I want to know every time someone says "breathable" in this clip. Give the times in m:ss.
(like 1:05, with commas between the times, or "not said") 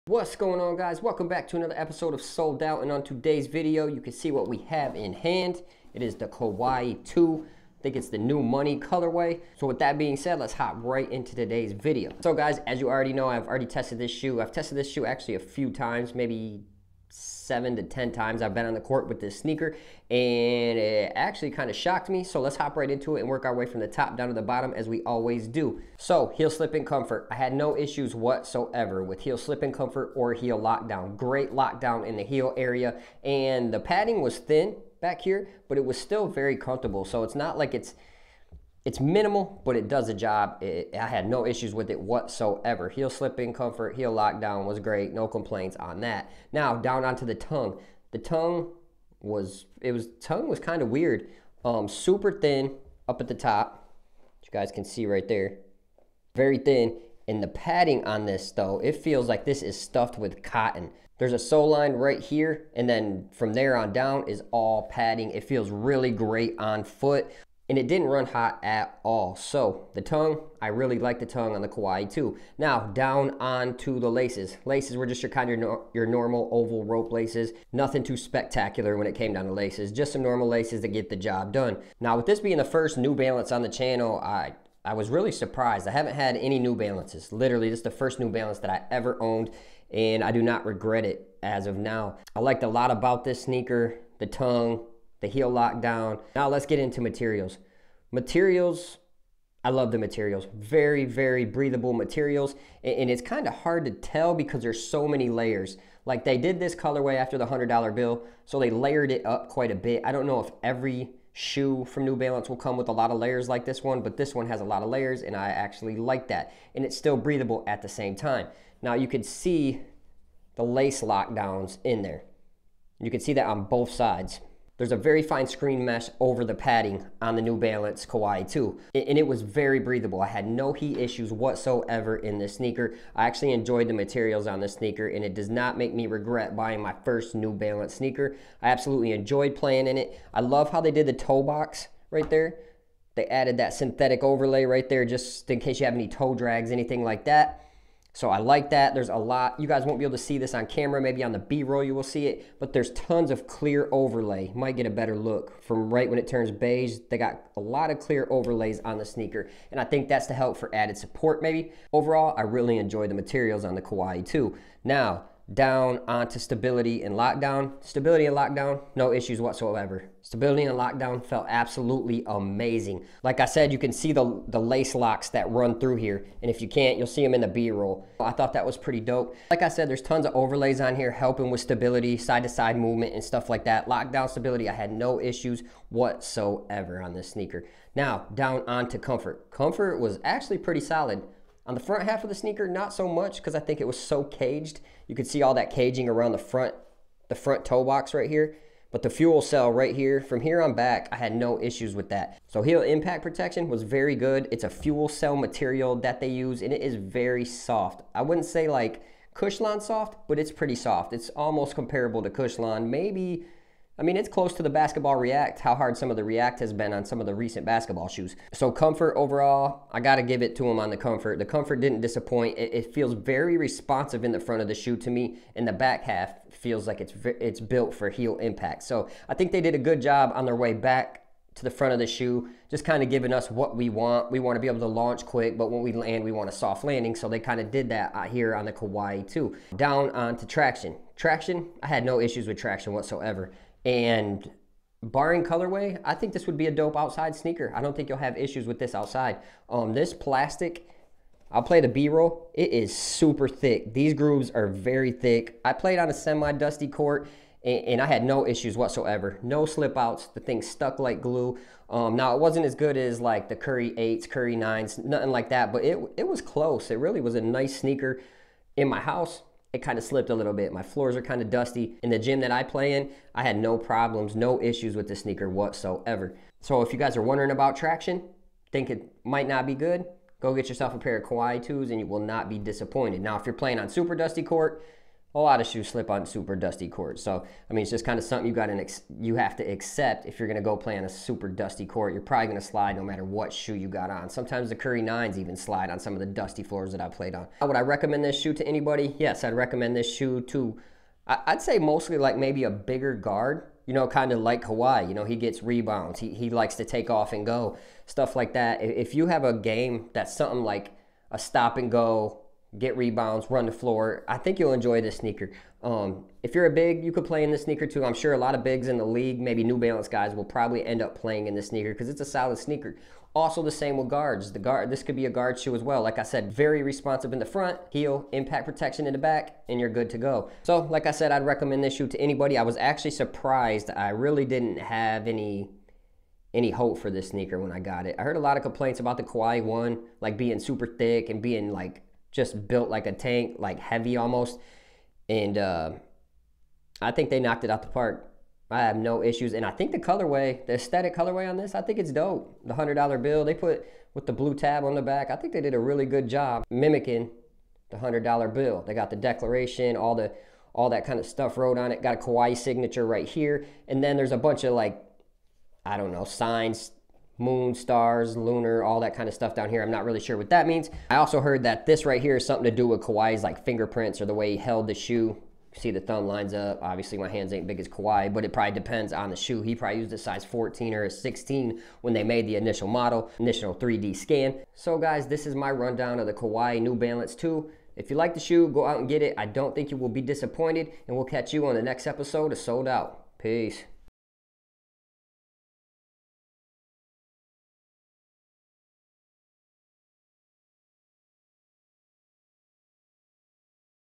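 1:41, 1:57, 2:09.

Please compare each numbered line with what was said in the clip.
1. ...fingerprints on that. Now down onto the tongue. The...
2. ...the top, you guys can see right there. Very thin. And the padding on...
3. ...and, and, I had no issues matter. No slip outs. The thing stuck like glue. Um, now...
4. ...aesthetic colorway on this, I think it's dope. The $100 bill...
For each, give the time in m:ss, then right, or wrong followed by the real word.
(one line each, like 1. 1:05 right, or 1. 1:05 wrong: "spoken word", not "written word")
1. 0:45 wrong: "complaints", not "fingerprints"
2. 0:53 right
3. 4:17 wrong: "whatsoever", not "matter"
4. 5:50 right.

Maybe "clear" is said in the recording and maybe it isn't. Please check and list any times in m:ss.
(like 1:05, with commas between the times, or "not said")
2:33, 2:37.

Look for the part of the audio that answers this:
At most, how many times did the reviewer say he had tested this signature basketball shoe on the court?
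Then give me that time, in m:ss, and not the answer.
0:17.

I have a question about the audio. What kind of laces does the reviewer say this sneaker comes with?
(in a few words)
oval rope laces.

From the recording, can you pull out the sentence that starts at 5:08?
If you have a game that's something like a stop and go get rebounds, run the floor.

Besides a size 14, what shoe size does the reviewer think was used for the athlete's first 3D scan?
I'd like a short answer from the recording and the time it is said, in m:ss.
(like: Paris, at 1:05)
16, at 6:21.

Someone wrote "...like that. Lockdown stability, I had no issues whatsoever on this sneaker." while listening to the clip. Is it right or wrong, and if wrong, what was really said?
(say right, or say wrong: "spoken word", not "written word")
right.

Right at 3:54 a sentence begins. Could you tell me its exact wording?
We want to be able to launch quick, but when we land, we want a soft landing.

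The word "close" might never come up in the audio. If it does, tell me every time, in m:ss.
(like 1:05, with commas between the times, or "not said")
3:34, 4:26.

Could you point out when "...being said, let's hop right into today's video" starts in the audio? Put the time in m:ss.
0:09.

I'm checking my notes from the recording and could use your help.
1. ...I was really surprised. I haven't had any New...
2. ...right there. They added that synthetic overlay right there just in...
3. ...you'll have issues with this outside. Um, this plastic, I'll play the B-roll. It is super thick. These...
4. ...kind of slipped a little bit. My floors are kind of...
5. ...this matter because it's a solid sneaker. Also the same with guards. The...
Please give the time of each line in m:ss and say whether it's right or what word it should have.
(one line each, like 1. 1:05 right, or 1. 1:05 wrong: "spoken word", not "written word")
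1. 1:24 right
2. 2:22 right
3. 4:08 right
4. 4:29 right
5. 5:21 wrong: "sneaker", not "matter".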